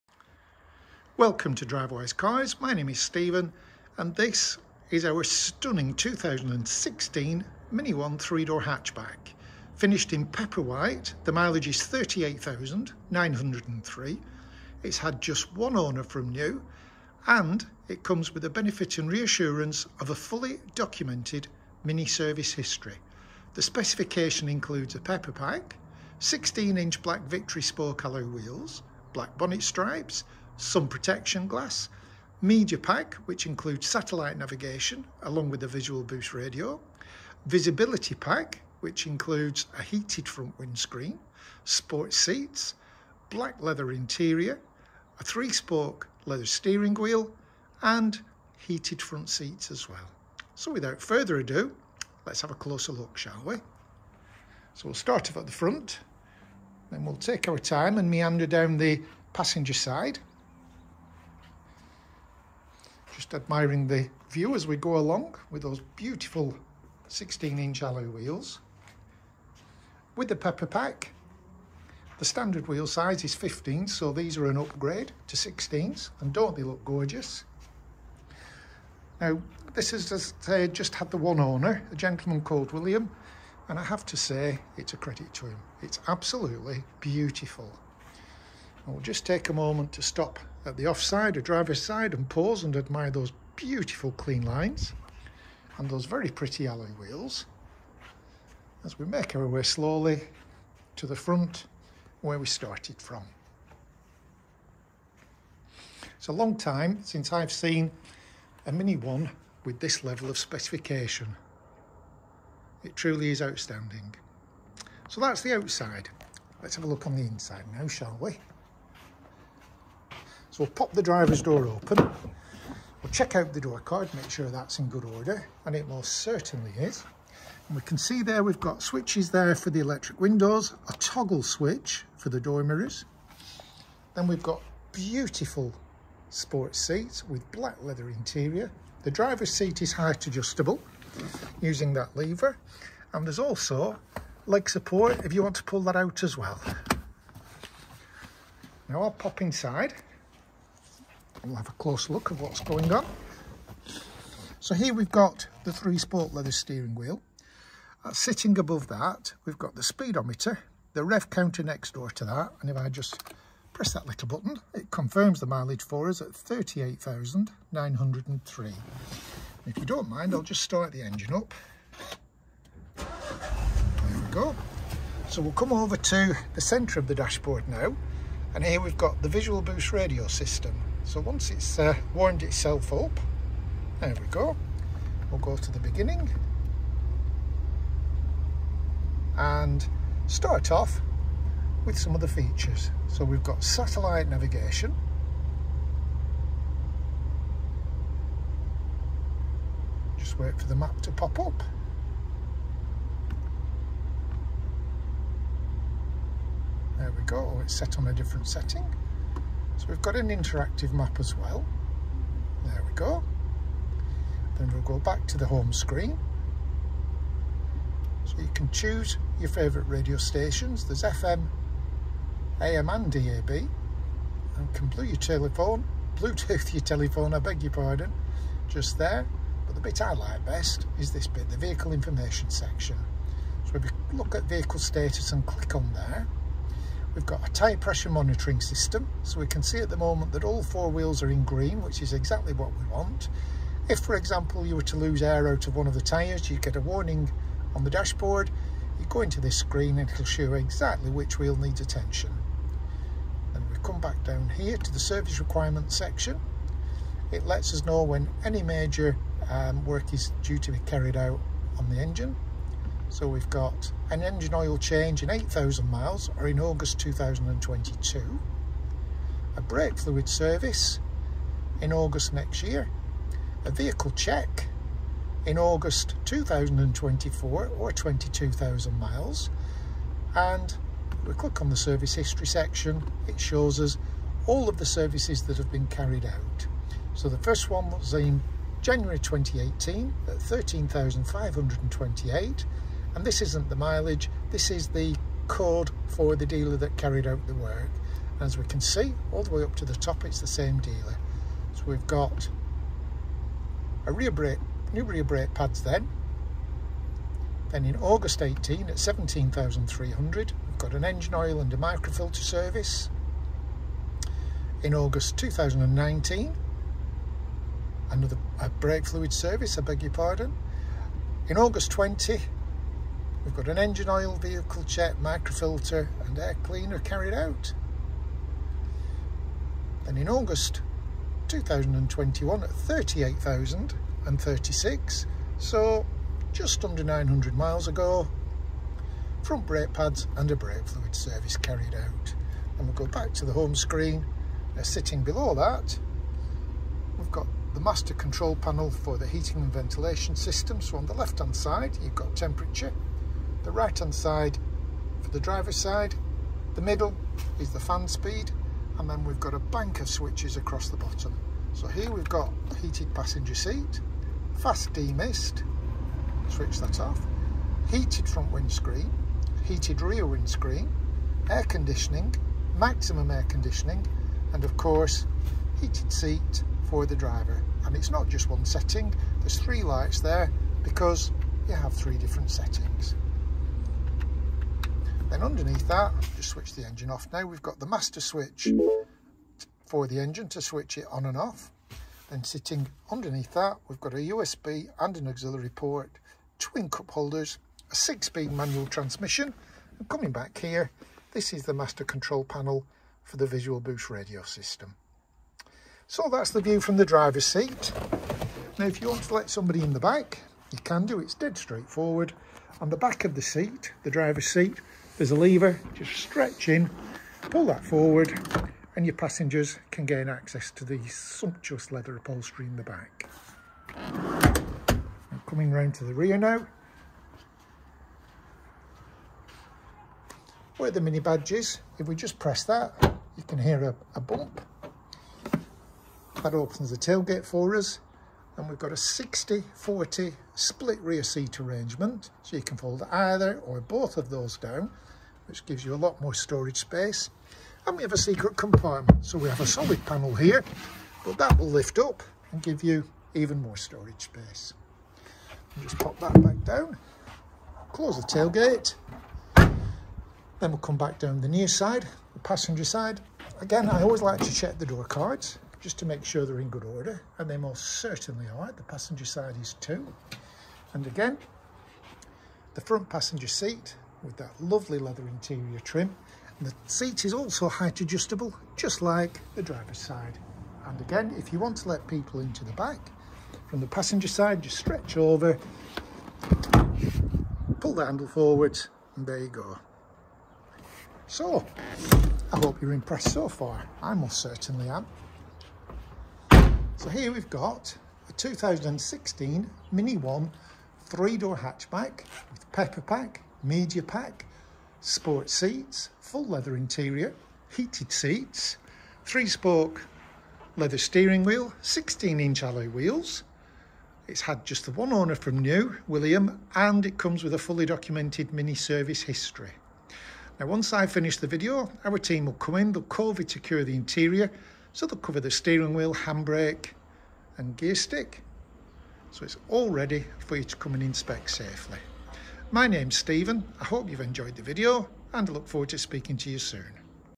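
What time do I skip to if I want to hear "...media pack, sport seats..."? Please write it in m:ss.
8:23.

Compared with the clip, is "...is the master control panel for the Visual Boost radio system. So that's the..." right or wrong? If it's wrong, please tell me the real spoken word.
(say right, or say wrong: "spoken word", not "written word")
right.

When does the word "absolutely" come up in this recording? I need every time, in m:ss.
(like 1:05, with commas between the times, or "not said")
1:26.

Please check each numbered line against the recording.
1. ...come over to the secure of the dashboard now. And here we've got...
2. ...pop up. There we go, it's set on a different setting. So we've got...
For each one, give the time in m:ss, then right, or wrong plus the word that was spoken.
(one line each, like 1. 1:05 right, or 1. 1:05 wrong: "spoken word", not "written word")
1. 2:55 wrong: "centre", not "secure"
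2. 3:21 right.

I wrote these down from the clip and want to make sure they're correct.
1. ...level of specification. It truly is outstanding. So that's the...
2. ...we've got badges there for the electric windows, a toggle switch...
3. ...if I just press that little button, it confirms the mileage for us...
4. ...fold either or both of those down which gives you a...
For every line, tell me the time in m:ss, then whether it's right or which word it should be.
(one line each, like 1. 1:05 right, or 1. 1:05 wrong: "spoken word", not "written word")
1. 1:50 right
2. 2:08 wrong: "switches", not "badges"
3. 2:42 right
4. 7:22 right.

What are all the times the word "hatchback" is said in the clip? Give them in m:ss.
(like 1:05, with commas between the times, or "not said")
0:08, 8:21.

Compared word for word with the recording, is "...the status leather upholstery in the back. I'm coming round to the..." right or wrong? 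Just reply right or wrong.
wrong.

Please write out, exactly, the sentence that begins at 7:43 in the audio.
Again, I always like to check the door cards just to make sure they're in good order.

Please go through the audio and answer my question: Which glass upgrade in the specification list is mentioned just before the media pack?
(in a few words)
Sun protection glass.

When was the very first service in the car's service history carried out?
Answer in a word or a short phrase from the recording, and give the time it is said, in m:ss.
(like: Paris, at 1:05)
January 2018, at 4:48.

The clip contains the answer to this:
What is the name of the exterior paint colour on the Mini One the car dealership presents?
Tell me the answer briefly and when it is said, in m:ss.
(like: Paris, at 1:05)
Pepper white, at 0:10.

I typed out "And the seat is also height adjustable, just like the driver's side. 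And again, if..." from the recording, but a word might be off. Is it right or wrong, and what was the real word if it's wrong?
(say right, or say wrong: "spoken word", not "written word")
right.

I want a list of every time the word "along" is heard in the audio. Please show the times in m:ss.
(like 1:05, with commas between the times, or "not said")
0:35, 1:04.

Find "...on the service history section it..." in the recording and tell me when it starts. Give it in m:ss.
4:41.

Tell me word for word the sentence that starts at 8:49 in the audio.
So it's all ready for you to come and inspect safely.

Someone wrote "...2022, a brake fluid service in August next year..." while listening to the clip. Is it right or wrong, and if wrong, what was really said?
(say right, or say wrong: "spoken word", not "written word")
right.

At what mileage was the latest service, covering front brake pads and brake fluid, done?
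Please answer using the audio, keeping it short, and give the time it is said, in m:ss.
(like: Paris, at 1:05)
38,036, at 5:32.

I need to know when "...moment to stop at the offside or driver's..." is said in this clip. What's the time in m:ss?
1:29.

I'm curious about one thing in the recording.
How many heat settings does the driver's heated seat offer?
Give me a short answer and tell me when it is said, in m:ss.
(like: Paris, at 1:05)
3, at 6:21.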